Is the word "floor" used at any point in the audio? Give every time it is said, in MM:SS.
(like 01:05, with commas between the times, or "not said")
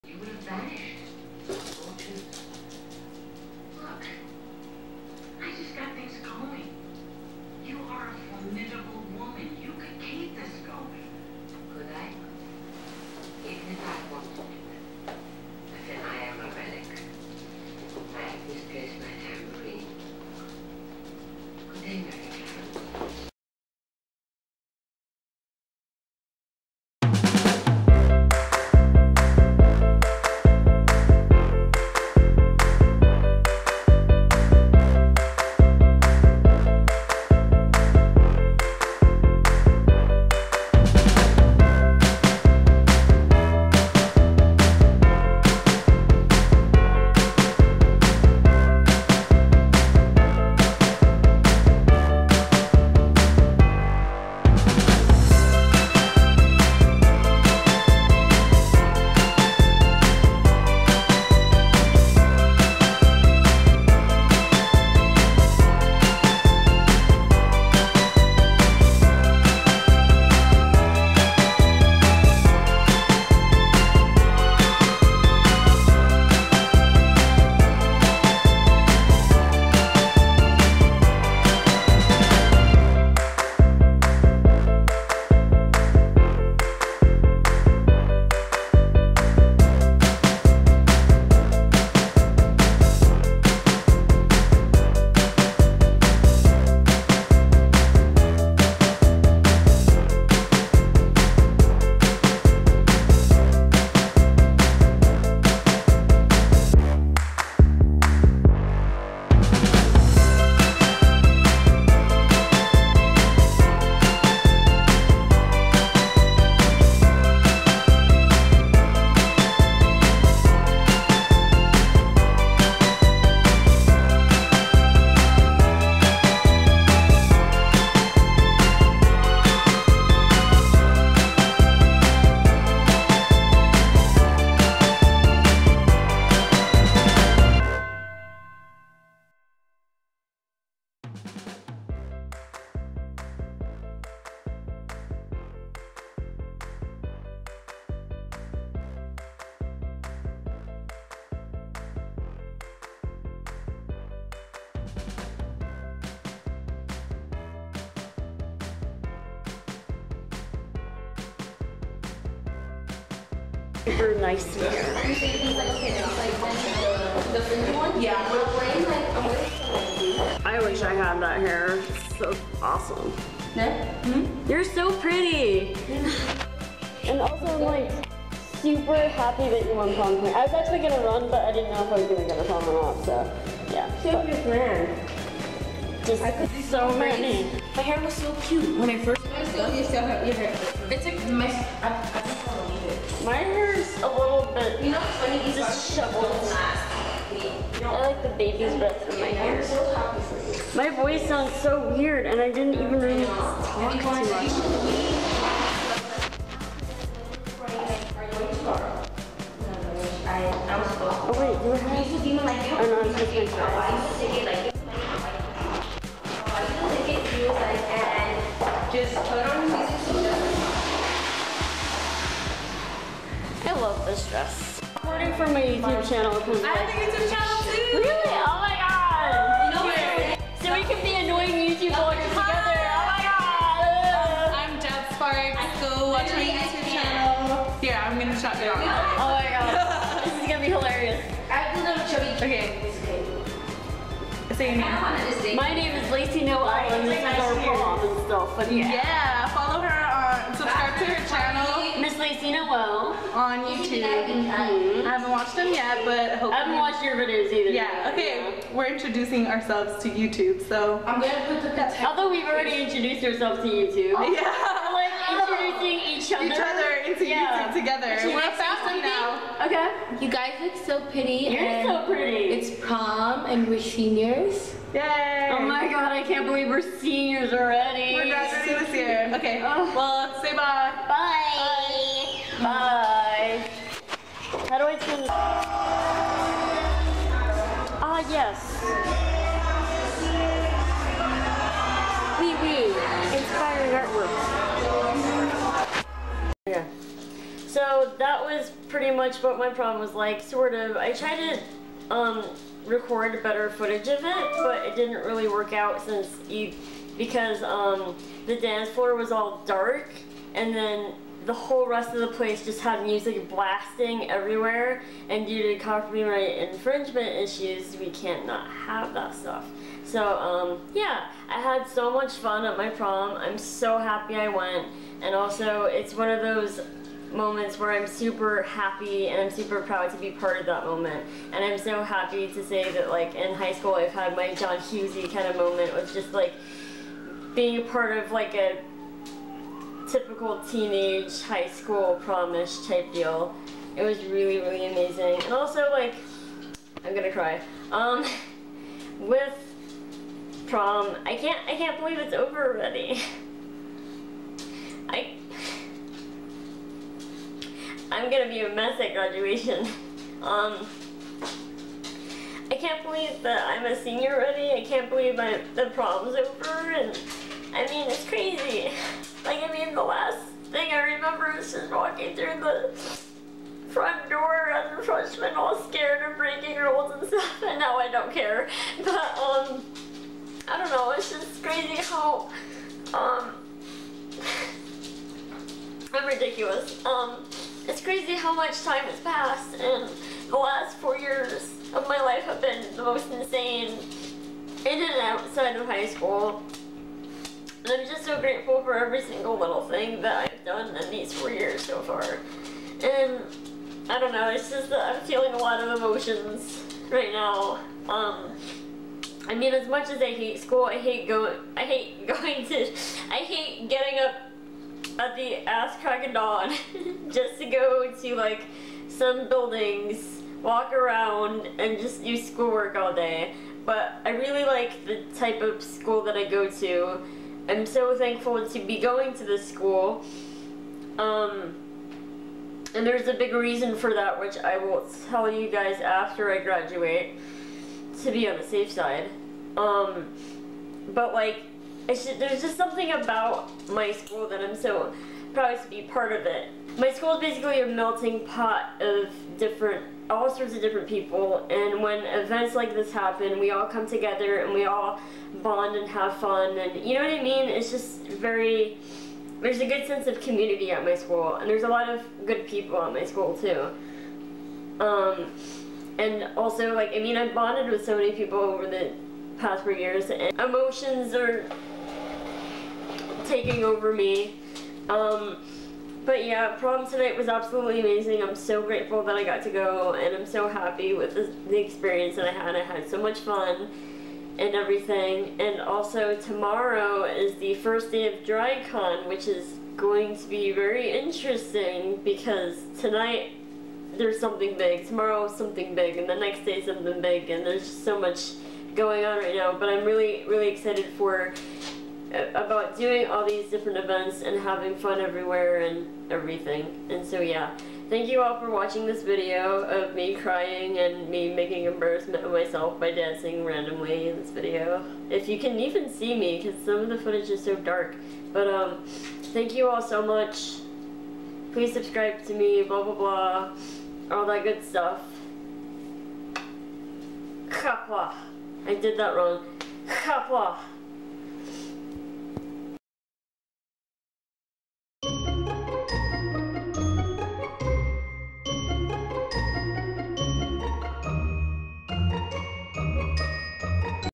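05:08.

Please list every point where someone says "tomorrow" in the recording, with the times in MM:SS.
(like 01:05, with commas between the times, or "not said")
08:06, 08:15.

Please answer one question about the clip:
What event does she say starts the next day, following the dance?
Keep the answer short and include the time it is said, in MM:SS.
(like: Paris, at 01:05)
DragCon, at 08:08.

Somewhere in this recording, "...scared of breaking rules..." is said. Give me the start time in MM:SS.
06:15.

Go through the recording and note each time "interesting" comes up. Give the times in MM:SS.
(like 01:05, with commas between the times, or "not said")
08:11.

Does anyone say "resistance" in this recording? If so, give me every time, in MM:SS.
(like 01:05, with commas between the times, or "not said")
not said.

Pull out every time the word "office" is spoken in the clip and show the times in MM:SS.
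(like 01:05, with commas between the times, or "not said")
not said.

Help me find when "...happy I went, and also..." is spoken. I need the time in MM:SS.
05:23.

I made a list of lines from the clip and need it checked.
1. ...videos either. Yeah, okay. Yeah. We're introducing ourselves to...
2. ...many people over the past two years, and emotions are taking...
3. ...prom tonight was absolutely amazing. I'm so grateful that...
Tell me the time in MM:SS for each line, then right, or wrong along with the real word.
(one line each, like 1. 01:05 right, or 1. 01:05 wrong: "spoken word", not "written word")
1. 04:17 right
2. 07:48 wrong: "four", not "two"
3. 07:56 right.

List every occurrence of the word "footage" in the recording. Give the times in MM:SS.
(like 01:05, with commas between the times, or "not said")
05:03, 08:37.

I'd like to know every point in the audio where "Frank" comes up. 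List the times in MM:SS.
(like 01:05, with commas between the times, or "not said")
not said.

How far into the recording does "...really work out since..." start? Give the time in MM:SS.
05:05.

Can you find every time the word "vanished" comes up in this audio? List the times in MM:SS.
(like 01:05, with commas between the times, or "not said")
00:00.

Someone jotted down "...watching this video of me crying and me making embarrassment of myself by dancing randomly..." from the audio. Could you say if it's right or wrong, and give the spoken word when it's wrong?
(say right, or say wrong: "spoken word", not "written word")
right.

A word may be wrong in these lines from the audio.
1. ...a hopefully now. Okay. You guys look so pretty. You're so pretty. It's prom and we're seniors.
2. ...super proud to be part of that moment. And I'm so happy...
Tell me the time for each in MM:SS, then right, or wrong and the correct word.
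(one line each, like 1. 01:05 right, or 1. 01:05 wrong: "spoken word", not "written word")
1. 04:28 wrong: "family", not "hopefully"
2. 05:29 right.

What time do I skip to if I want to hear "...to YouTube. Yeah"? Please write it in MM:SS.
04:23.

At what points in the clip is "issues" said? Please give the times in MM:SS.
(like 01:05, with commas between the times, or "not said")
05:17.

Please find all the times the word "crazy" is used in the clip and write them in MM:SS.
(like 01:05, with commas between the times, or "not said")
06:08, 06:21, 06:28.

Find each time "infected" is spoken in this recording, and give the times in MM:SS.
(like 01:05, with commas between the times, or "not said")
not said.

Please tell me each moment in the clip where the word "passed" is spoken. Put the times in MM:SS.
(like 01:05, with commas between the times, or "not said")
06:29.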